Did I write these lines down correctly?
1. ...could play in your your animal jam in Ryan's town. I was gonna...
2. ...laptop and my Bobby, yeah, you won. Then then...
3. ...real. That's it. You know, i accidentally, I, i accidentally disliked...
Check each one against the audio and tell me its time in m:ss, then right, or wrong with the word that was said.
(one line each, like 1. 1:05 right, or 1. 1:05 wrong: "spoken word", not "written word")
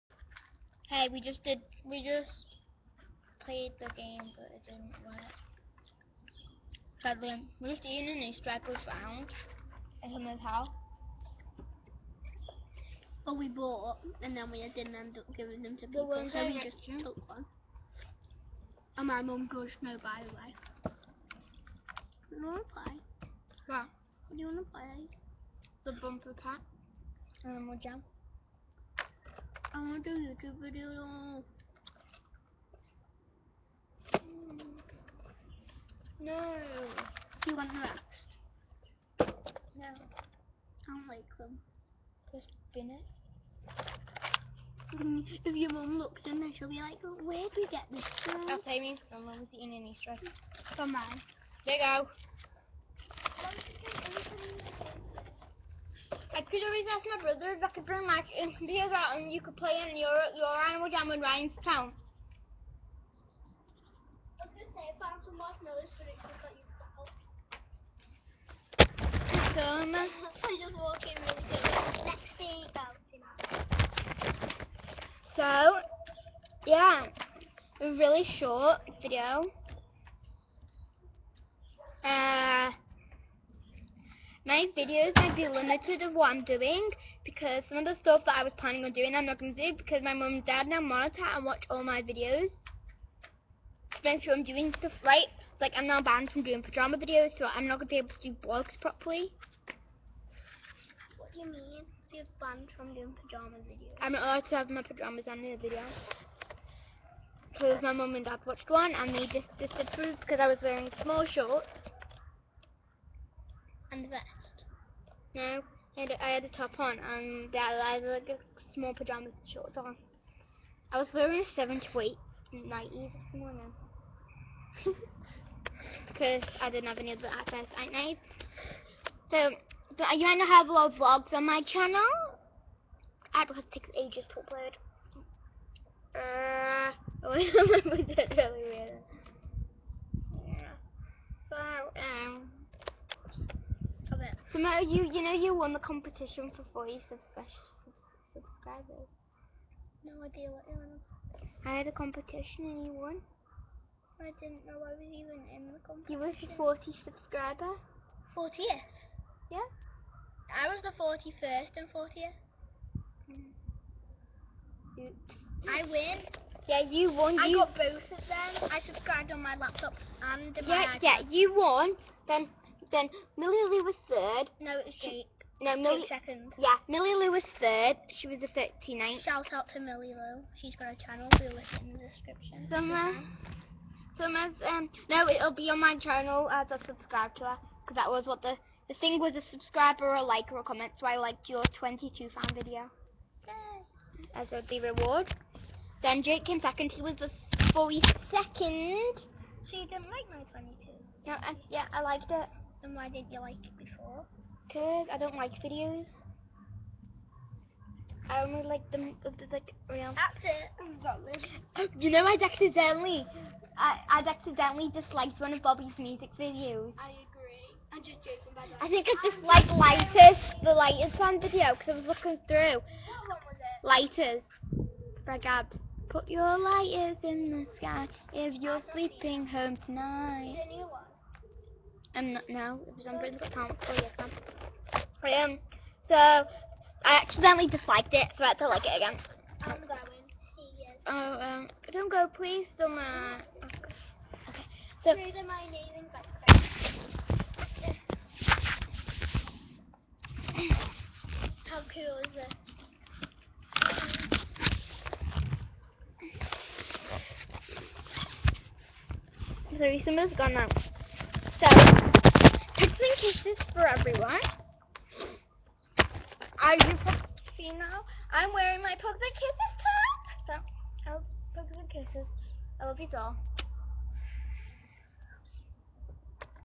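1. 0:59 right
2. 2:49 wrong: "Yeah", not "Bobby"
3. 3:29 right.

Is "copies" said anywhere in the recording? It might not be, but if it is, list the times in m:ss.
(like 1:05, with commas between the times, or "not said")
not said.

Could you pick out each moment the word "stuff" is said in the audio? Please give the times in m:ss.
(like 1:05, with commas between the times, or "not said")
1:28, 1:34.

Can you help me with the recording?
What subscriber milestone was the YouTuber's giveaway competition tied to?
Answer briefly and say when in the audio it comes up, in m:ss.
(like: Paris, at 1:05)
40, at 2:26.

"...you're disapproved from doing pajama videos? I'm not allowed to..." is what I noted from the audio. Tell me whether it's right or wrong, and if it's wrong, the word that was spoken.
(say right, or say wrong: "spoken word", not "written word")
wrong: "banned", not "disapproved".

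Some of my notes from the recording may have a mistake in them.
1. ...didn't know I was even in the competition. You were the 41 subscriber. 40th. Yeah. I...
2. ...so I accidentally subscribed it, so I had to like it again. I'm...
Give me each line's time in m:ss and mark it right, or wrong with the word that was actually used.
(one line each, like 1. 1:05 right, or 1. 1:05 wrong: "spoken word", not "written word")
1. 2:34 wrong: "40", not "41"
2. 3:56 wrong: "disliked", not "subscribed".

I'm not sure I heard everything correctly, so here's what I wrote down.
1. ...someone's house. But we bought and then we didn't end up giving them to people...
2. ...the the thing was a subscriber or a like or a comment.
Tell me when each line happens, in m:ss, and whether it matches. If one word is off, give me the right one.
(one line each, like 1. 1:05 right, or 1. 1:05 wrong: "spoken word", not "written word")
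1. 0:10 right
2. 3:08 right.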